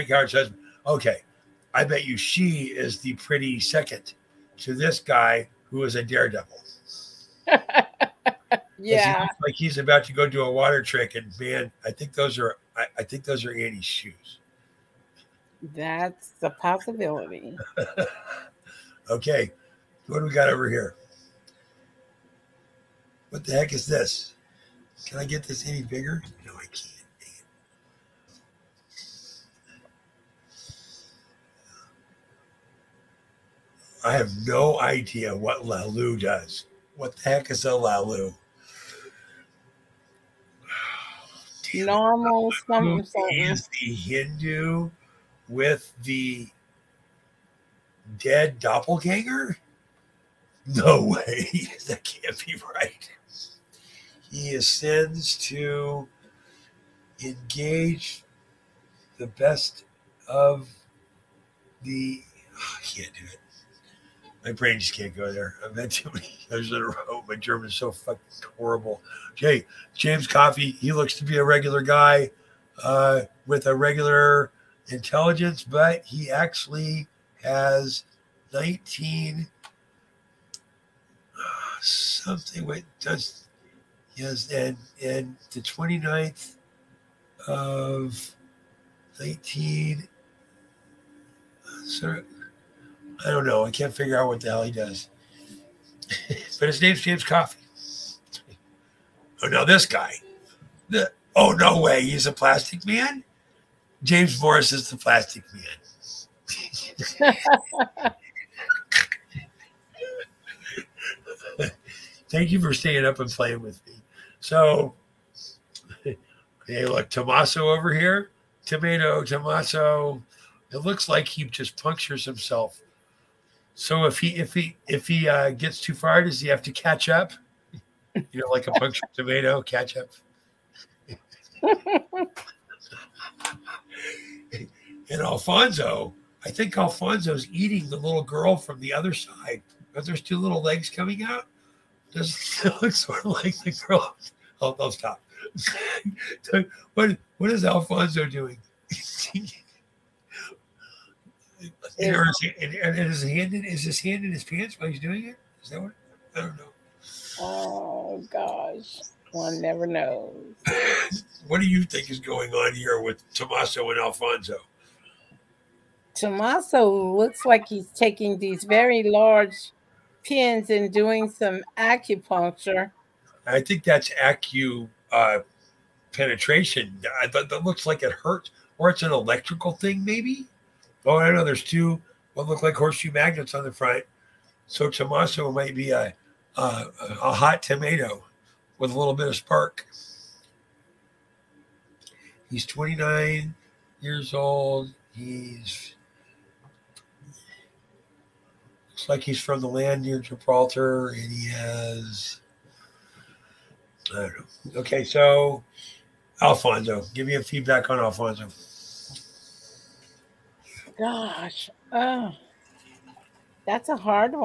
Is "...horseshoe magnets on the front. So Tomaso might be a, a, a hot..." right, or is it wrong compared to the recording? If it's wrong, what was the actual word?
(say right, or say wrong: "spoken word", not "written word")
right.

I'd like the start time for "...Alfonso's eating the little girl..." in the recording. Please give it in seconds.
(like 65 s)
136 s.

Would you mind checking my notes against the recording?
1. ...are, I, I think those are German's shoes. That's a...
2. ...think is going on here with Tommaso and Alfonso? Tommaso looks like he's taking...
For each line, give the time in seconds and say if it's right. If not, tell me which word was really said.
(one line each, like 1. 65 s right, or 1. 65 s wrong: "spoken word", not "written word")
1. 12 s wrong: "Annie", not "German"
2. 161 s right.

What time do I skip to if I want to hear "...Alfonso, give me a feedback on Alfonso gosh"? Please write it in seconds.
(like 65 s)
206 s.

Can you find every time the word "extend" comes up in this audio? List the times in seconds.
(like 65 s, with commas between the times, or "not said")
not said.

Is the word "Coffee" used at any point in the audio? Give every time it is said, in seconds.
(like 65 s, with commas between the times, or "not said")
70 s, 97 s.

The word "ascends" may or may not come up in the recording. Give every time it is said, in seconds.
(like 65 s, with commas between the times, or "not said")
54 s.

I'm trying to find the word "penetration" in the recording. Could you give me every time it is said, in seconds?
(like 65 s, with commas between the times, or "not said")
176 s.